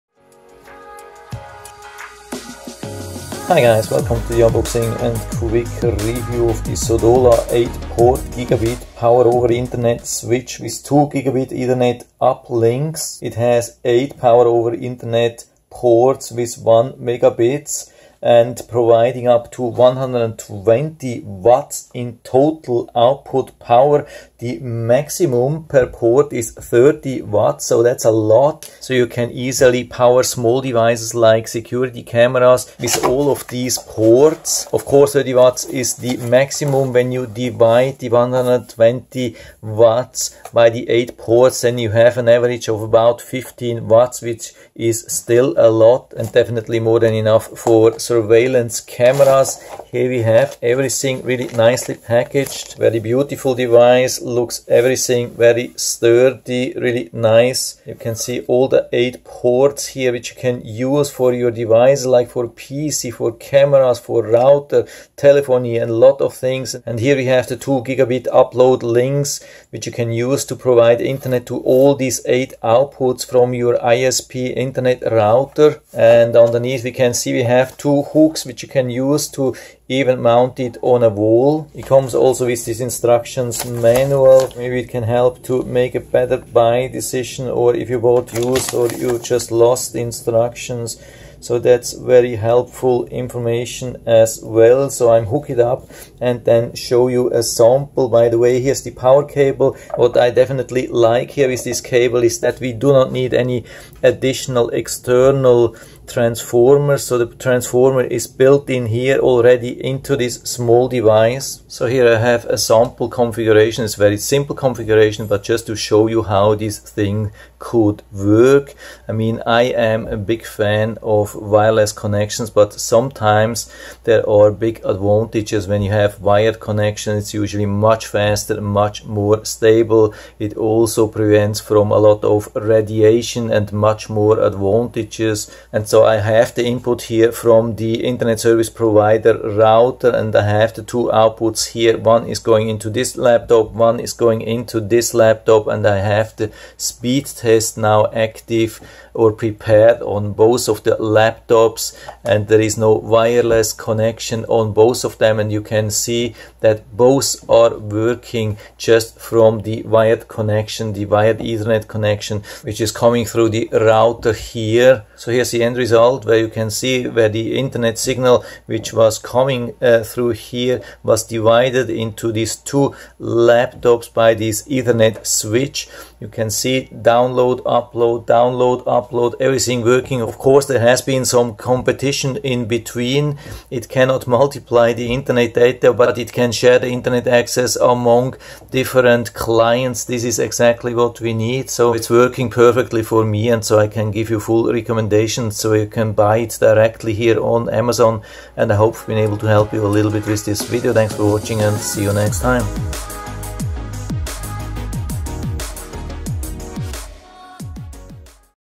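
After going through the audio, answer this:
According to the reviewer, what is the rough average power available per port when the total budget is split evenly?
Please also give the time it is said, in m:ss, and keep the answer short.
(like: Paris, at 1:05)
15 watts, at 0:43.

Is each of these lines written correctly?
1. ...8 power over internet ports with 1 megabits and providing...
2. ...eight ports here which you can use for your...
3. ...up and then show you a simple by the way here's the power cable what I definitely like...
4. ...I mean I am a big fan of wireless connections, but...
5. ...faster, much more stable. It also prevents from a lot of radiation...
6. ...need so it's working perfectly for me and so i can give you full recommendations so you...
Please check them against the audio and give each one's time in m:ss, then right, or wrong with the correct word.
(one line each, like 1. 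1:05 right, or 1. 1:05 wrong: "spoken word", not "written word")
1. 0:13 right
2. 0:58 right
3. 1:35 wrong: "sample", not "simple"
4. 1:59 right
5. 2:08 right
6. 3:11 right.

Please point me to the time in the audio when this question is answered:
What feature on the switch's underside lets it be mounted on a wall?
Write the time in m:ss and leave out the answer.
1:17.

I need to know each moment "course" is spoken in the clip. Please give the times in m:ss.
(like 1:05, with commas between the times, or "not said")
0:34, 3:00.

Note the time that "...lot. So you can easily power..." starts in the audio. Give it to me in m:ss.
0:28.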